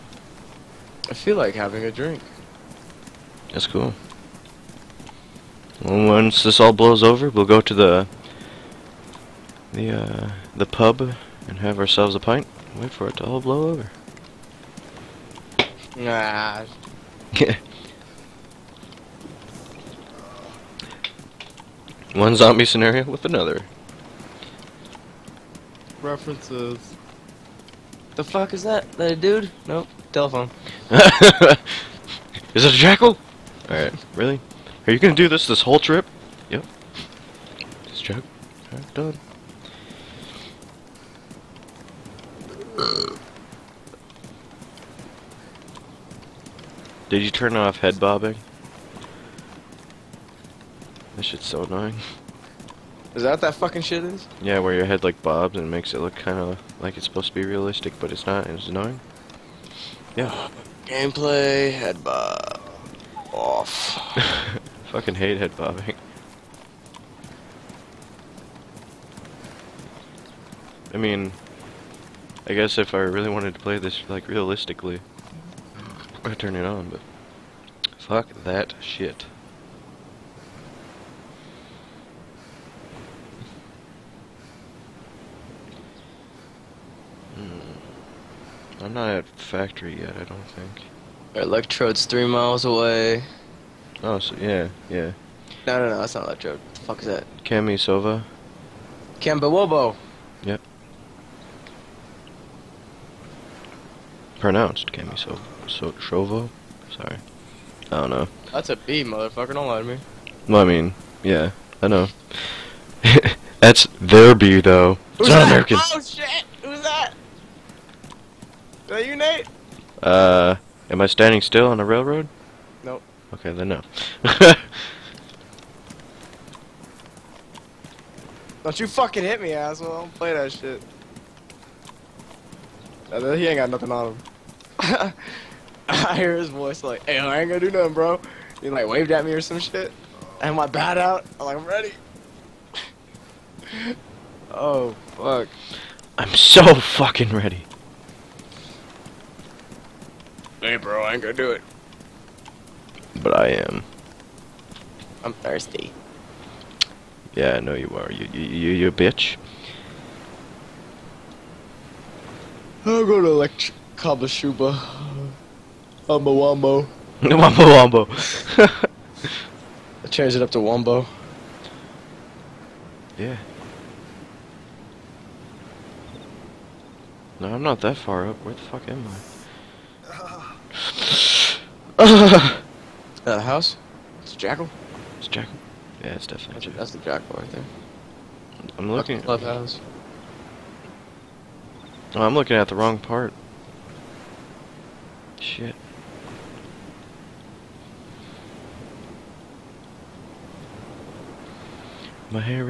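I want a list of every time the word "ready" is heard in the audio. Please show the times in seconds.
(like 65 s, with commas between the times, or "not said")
141 s, 147 s.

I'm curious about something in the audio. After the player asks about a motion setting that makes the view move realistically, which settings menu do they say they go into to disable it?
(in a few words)
Gameplay.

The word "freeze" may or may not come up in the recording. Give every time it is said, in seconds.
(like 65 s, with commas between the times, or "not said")
not said.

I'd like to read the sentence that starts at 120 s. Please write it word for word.
Uh, am I standing still on the railroad?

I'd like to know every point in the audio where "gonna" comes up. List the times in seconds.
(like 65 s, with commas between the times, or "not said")
34 s, 137 s, 151 s.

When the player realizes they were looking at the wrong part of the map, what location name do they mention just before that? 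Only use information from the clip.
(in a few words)
Clubhouse.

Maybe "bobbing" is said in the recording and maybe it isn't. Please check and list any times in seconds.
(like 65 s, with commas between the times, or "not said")
48 s, 65 s.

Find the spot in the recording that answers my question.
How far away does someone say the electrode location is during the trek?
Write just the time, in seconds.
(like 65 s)
92 s.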